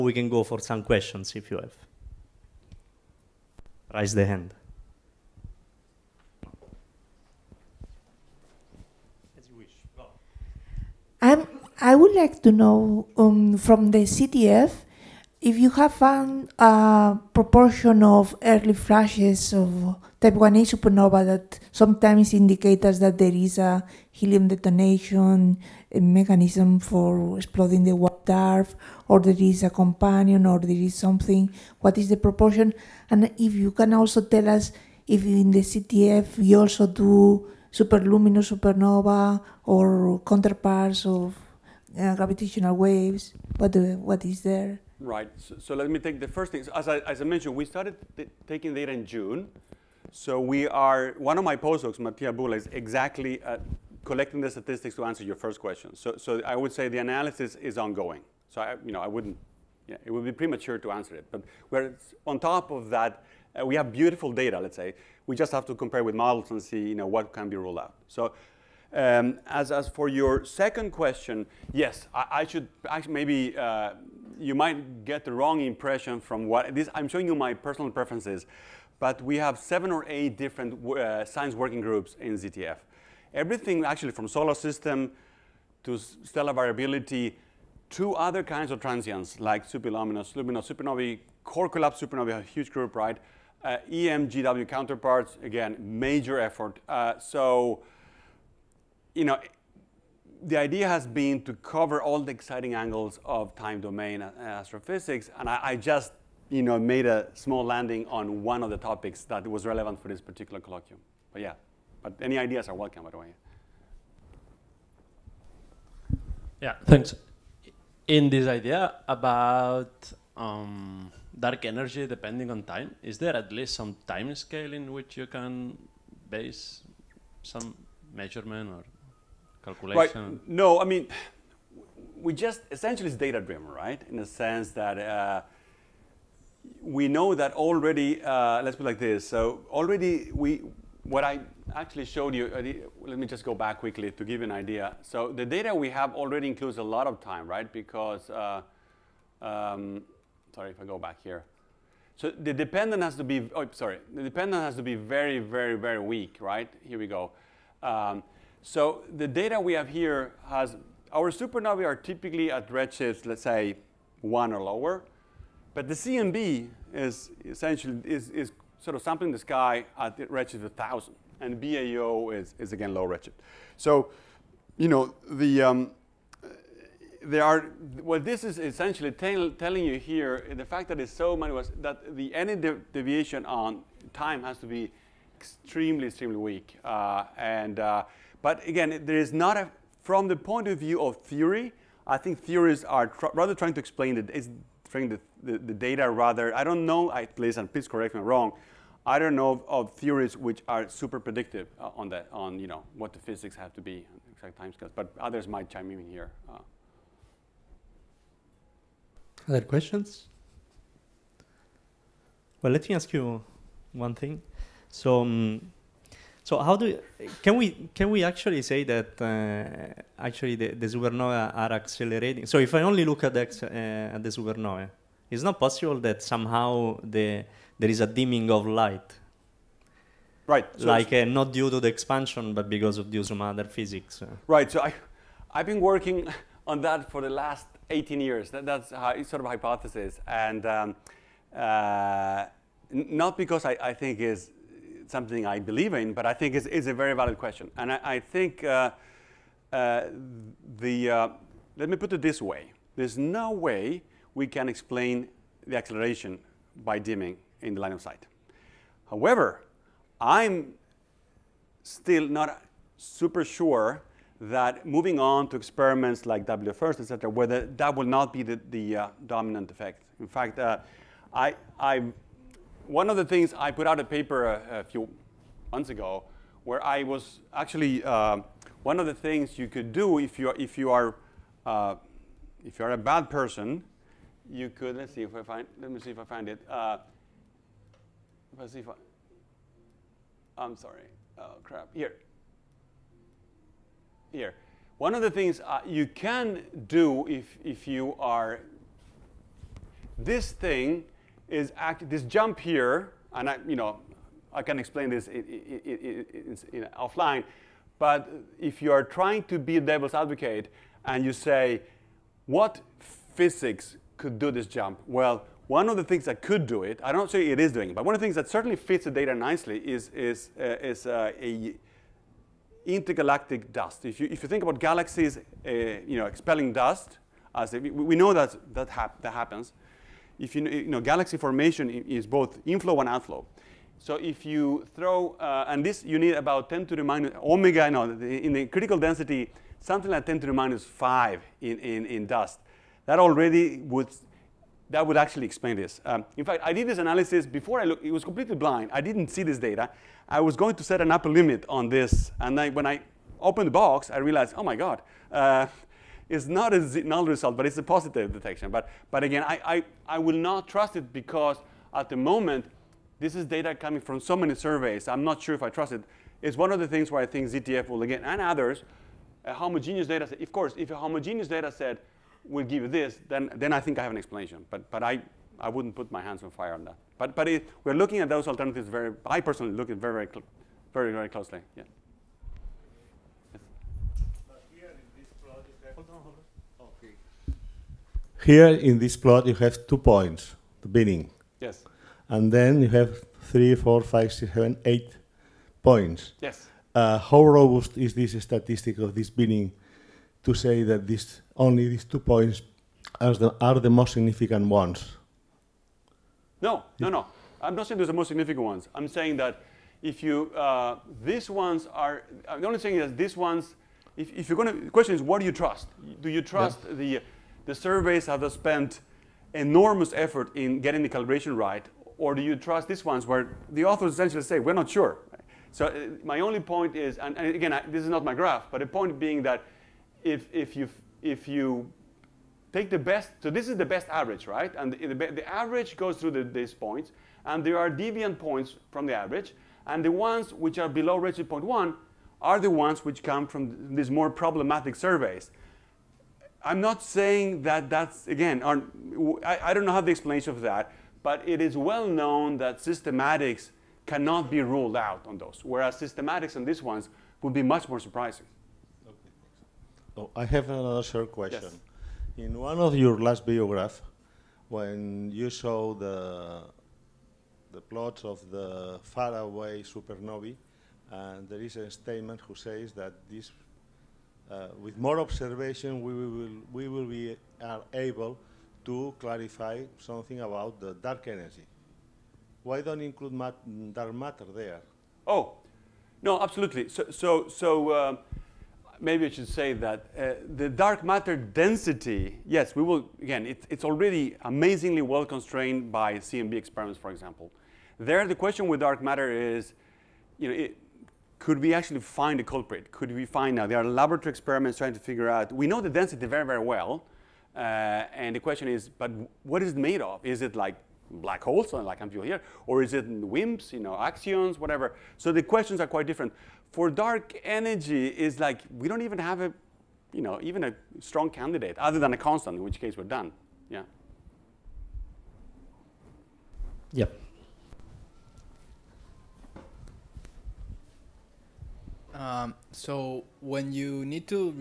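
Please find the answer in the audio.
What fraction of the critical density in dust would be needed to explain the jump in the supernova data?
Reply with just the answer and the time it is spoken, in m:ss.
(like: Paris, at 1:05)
10 to the minus 5, at 5:40.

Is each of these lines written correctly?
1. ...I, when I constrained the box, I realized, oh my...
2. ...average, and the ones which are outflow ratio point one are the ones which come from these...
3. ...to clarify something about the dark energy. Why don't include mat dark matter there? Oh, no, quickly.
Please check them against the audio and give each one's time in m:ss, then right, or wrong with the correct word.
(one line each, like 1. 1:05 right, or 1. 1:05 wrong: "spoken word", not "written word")
1. 5:52 wrong: "opened", not "constrained"
2. 7:19 wrong: "below", not "outflow"
3. 7:58 wrong: "absolutely", not "quickly".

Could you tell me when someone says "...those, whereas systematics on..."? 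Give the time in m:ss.
7:35.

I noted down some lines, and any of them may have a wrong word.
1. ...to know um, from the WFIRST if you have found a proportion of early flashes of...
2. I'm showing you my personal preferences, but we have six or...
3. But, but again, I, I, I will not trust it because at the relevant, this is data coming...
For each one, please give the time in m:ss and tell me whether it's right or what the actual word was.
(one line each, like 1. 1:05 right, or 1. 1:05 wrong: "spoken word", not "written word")
1. 0:12 wrong: "ZTF", not "WFIRST"
2. 1:16 wrong: "seven", not "six"
3. 5:58 wrong: "moment", not "relevant".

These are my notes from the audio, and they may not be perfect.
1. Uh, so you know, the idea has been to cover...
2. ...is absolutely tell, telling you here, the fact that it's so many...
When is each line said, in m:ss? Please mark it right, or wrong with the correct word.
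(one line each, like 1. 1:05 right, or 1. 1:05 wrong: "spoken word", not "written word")
1. 1:36 right
2. 2:58 wrong: "essentially", not "absolutely".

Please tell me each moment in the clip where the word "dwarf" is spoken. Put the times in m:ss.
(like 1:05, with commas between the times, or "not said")
0:28.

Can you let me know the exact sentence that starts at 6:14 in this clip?
But, but I, I wouldn't put my hands on fire on that.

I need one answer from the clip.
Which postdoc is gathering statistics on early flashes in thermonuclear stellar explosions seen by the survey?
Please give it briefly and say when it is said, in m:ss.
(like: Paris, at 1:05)
Mattia Bulla, at 0:51.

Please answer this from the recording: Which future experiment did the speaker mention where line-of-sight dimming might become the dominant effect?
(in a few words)
WFIRST.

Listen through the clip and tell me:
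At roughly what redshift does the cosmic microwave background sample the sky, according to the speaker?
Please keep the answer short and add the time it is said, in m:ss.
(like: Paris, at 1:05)
1,000, at 2:50.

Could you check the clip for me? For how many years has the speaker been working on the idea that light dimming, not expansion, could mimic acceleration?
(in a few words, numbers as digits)
18.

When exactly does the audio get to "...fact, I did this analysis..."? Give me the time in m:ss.
5:46.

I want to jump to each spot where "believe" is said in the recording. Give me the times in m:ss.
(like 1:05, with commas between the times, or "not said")
4:05.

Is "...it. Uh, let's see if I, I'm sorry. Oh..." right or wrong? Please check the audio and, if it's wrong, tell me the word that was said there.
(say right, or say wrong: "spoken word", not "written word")
right.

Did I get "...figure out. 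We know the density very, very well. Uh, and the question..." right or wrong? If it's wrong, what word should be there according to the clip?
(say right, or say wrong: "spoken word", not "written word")
right.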